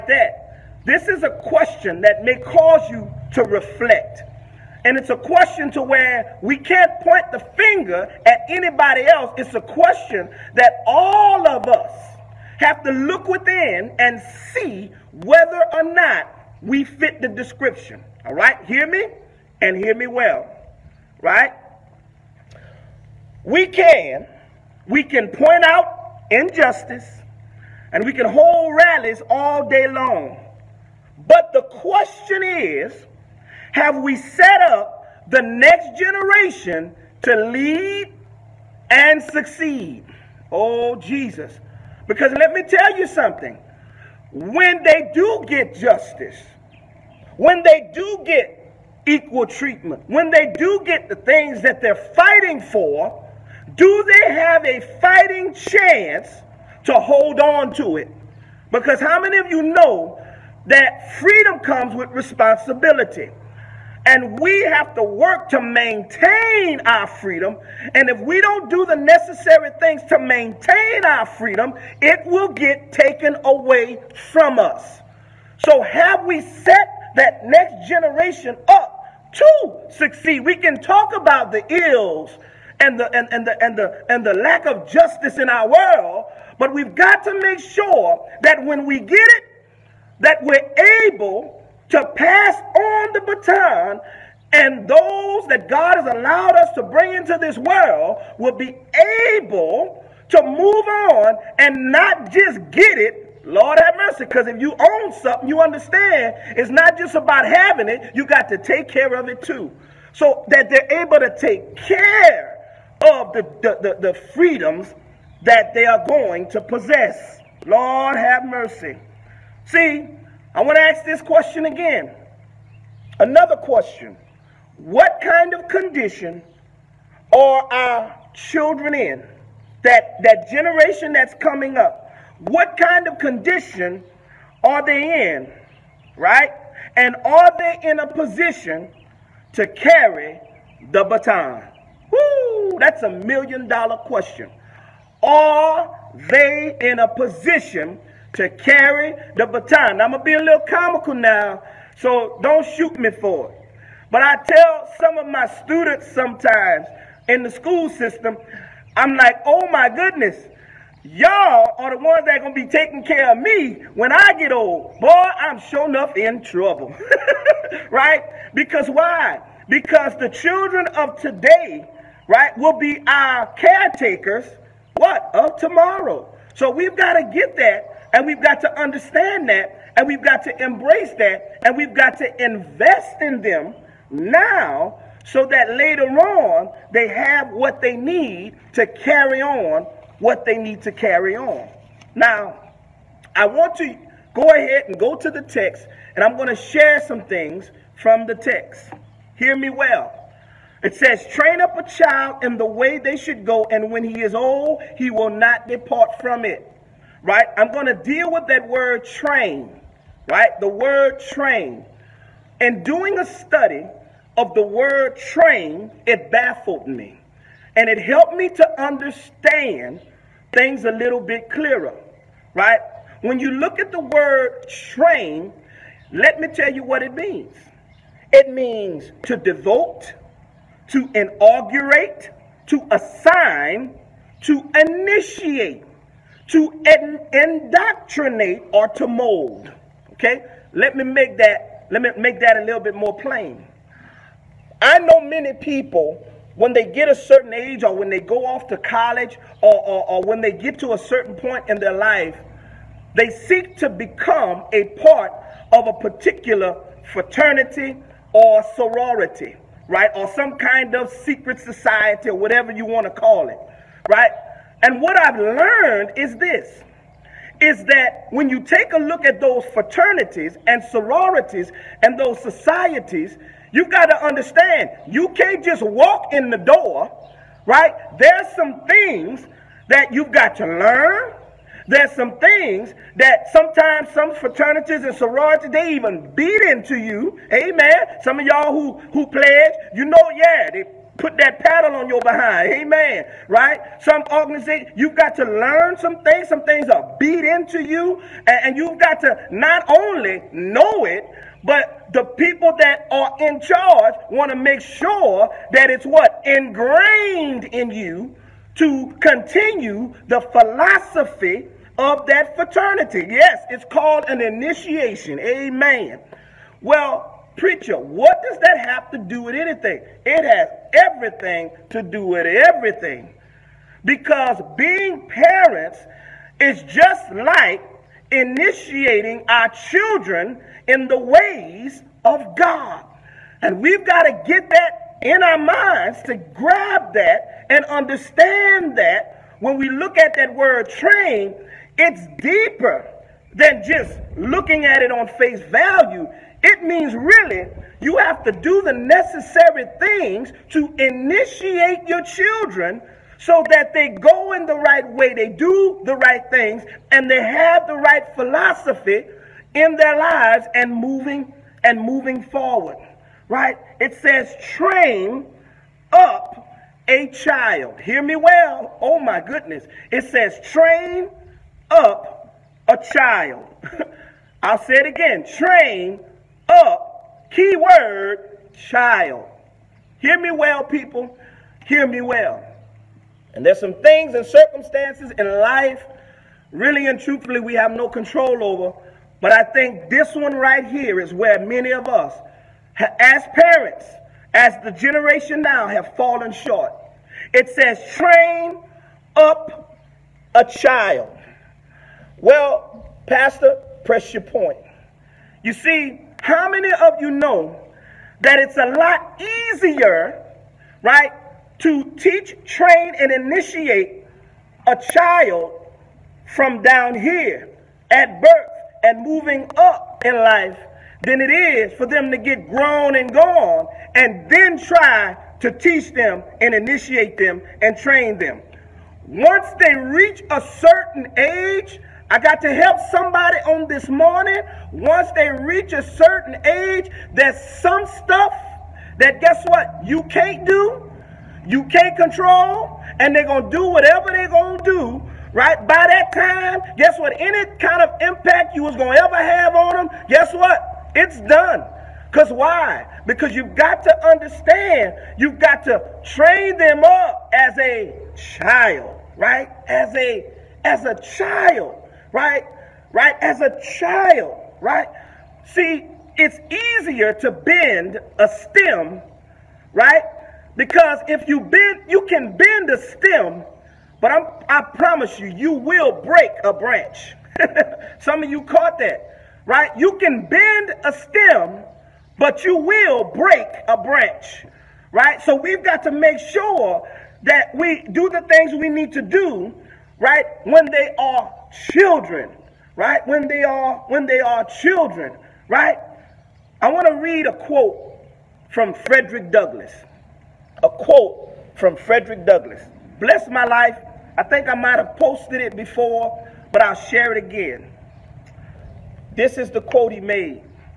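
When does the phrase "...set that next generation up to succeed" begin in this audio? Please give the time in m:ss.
1:16.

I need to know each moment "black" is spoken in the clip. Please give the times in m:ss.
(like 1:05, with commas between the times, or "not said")
not said.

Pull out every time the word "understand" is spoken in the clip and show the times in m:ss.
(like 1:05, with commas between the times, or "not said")
1:45, 2:58, 3:38, 4:34, 5:37, 7:34.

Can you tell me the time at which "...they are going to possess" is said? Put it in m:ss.
1:55.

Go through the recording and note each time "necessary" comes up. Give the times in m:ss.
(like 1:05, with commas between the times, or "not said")
1:08, 5:48.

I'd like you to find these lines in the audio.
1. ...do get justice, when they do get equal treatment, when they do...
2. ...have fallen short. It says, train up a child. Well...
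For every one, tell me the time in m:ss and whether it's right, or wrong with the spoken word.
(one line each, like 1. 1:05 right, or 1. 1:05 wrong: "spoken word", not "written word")
1. 0:45 right
2. 6:35 right.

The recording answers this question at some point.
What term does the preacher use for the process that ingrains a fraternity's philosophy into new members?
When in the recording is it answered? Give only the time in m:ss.
5:14.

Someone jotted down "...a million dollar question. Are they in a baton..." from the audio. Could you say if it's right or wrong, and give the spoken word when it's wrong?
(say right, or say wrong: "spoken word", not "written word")
wrong: "position", not "baton".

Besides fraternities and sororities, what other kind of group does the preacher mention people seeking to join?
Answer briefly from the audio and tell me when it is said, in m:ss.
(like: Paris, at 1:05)
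secret society, at 4:21.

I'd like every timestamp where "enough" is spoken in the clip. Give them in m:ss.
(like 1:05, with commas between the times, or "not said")
2:45.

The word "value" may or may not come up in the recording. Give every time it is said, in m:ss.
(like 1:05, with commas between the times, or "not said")
5:45.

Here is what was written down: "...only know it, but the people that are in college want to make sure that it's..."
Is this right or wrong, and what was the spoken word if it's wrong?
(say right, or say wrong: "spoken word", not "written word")
wrong: "charge", not "college".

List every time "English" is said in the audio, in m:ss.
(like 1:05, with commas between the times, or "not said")
not said.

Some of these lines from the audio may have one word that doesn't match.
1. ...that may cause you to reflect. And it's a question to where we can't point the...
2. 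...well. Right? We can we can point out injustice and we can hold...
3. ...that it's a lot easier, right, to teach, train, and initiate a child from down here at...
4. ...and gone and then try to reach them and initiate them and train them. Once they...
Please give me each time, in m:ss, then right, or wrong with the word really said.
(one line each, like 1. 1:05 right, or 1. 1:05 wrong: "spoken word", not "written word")
1. 0:02 right
2. 0:20 right
3. 6:48 right
4. 7:03 wrong: "teach", not "reach".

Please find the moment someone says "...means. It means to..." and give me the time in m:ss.
3:47.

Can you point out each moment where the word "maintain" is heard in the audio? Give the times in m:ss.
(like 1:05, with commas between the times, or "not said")
1:05, 1:10.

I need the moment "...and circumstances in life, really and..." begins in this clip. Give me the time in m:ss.
6:24.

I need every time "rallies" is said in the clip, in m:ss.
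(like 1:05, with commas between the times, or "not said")
0:28.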